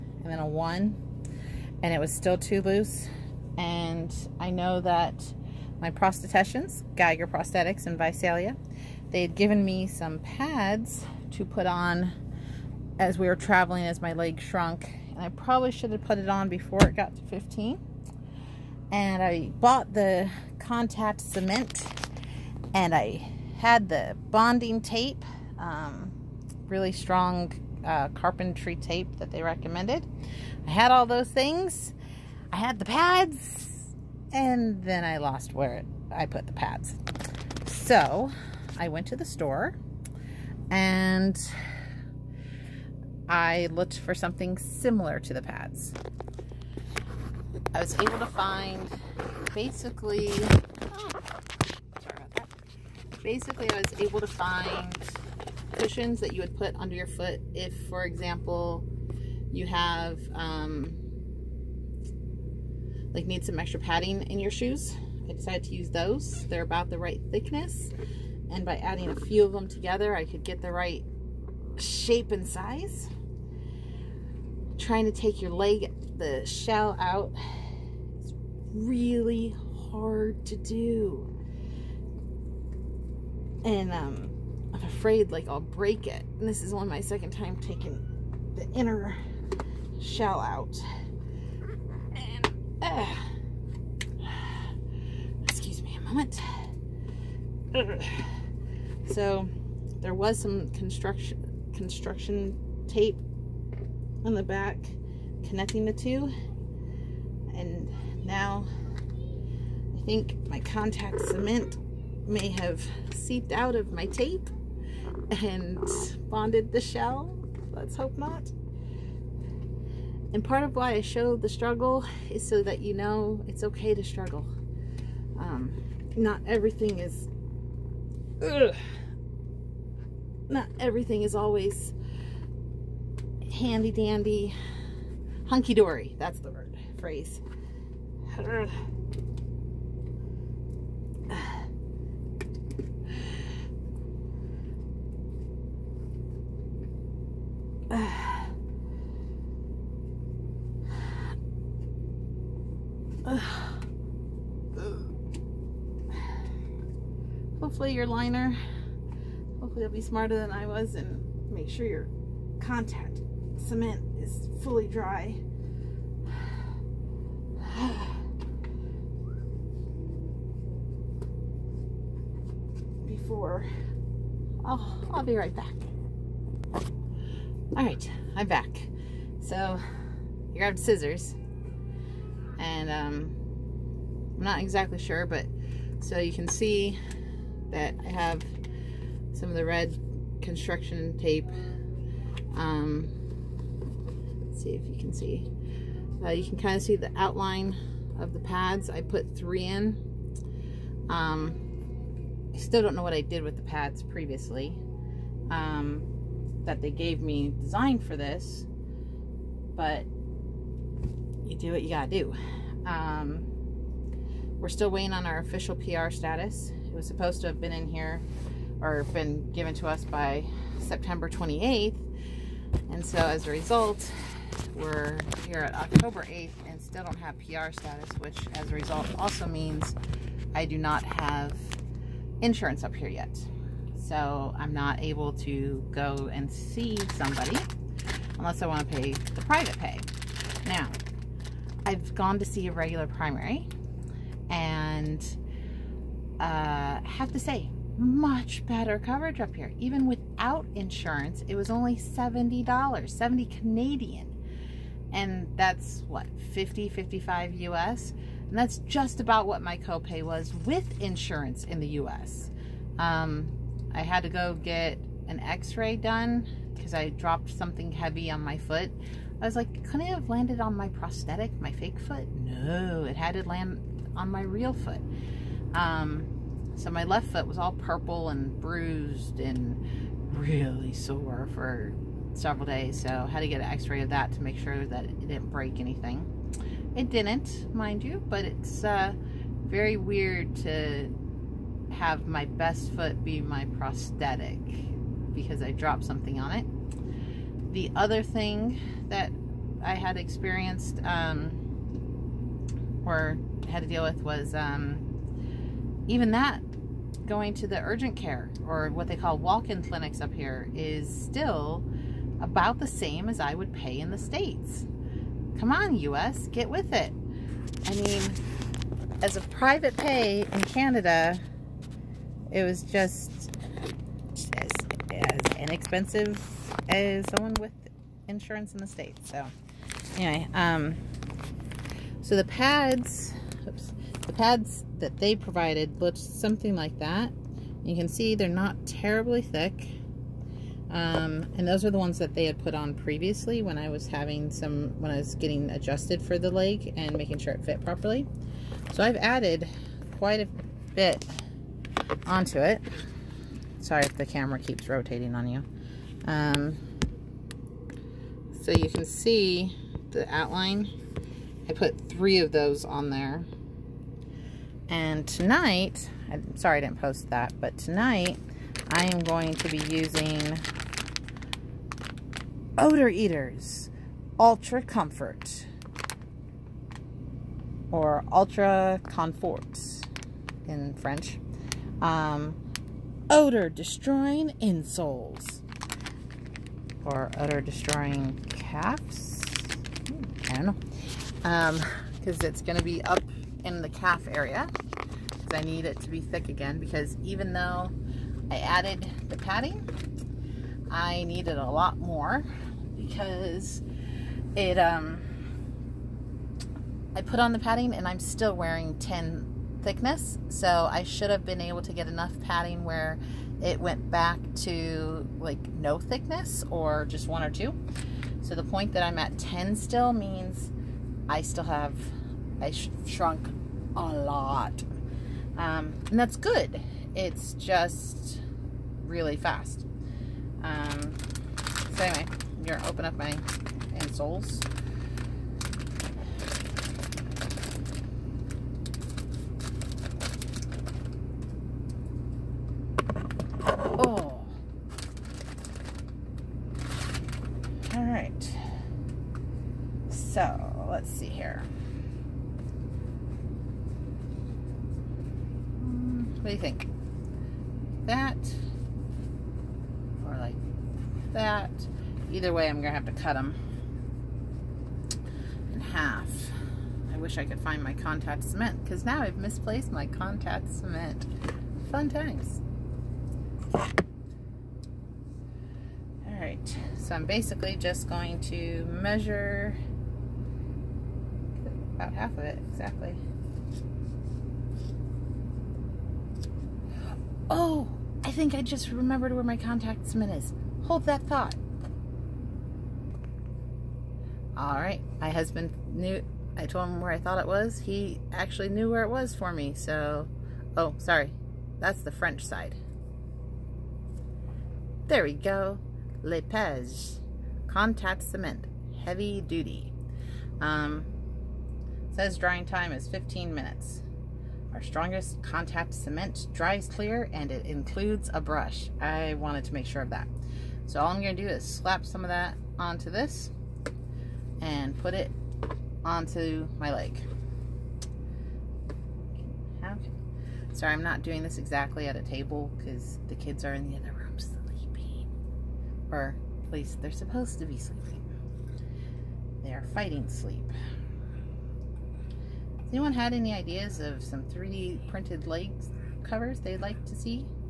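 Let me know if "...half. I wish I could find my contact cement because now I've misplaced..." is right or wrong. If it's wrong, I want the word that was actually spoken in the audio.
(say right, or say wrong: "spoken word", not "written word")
right.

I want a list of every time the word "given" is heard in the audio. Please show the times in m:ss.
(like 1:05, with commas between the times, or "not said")
0:09, 3:39.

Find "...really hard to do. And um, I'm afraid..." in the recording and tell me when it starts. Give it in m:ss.
1:18.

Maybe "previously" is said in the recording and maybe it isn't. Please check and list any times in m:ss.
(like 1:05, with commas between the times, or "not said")
3:24, 5:42.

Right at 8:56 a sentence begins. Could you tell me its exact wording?
Or at least they're supposed to be sleeping.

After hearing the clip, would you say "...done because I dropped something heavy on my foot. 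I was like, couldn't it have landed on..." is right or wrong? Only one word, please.
right.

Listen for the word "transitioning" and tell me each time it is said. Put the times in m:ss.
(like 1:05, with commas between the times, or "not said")
not said.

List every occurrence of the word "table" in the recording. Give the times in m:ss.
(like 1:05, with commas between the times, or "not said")
8:52.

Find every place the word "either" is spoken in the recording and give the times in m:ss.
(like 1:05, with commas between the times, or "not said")
7:42.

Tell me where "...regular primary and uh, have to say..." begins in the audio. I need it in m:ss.
4:02.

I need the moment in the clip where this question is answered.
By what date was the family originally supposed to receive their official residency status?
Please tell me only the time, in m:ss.
3:40.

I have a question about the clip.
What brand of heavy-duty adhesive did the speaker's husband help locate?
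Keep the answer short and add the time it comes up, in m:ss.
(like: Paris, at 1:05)
Lepage, at 8:26.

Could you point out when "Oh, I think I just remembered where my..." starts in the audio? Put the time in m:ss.
8:07.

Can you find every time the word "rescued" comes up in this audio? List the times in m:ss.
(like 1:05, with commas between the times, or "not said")
not said.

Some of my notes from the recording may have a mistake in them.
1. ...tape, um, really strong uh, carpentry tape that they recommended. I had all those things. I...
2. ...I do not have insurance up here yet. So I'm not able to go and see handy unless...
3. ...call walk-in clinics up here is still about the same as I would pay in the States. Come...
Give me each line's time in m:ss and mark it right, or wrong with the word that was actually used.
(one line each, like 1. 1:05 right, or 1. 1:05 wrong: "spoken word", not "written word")
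1. 0:24 right
2. 3:50 wrong: "somebody", not "handy"
3. 5:09 right.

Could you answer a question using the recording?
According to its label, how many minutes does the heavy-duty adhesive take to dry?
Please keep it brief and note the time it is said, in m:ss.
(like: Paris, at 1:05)
15 minutes, at 8:33.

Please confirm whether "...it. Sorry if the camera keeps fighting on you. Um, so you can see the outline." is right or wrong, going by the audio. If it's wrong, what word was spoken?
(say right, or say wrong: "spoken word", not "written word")
wrong: "rotating", not "fighting".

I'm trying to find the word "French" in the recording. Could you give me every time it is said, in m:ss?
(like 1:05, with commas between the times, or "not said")
6:20, 8:22.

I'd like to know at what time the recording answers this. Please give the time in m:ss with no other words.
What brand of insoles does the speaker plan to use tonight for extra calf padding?
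6:12.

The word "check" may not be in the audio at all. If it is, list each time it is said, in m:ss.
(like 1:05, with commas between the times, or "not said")
not said.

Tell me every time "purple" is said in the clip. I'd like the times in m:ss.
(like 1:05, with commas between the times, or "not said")
4:37.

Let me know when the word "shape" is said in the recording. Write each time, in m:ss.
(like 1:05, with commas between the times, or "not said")
1:11.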